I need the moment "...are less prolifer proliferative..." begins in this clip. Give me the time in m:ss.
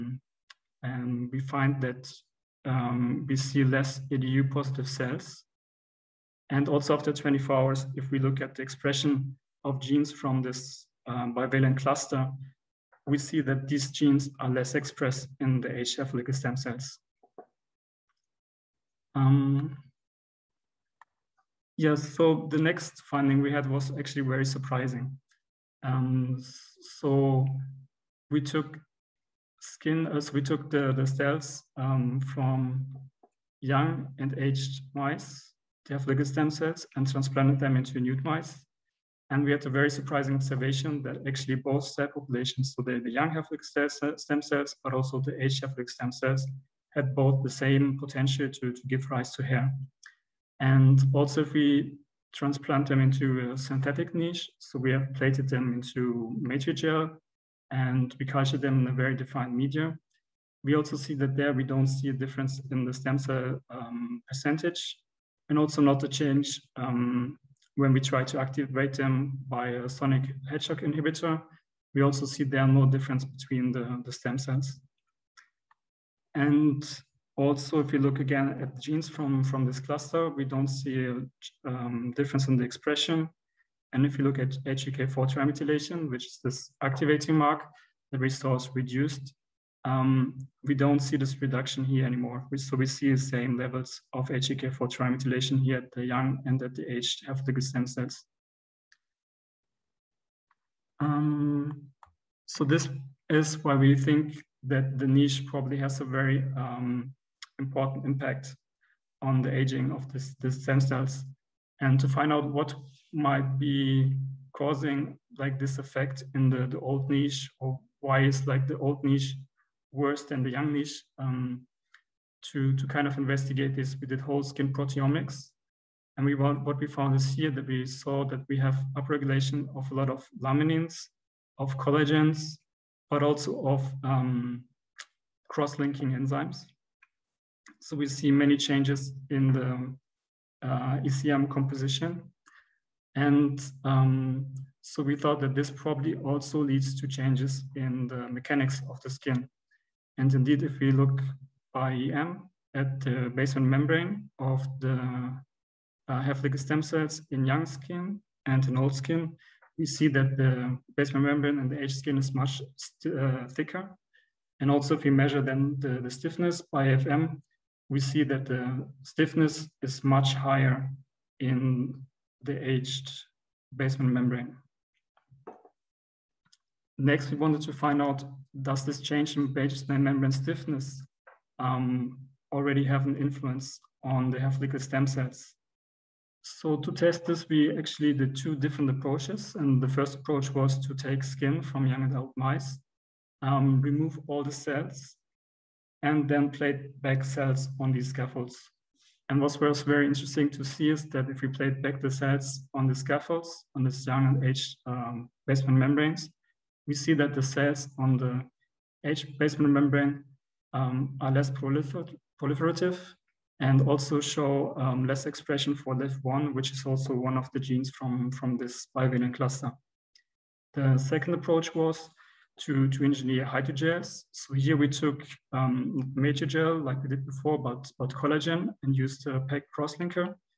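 3:31.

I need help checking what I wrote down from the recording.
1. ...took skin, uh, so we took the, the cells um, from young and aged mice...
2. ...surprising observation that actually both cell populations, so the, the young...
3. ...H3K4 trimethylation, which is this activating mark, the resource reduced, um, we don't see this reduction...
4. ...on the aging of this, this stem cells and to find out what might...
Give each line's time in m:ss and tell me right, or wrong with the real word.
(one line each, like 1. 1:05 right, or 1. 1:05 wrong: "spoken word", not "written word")
1. 0:28 right
2. 0:39 right
3. 1:24 right
4. 1:49 right.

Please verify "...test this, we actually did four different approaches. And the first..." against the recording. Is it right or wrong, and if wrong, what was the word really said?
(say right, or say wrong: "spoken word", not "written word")
wrong: "two", not "four".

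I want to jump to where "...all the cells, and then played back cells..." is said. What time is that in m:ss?
3:14.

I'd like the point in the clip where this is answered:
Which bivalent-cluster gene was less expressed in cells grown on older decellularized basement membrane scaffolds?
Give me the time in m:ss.
3:35.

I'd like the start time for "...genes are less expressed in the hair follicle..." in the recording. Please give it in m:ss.
0:13.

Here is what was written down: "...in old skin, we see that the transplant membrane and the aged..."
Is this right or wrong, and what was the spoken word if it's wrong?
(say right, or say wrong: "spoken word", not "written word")
wrong: "basement", not "transplant".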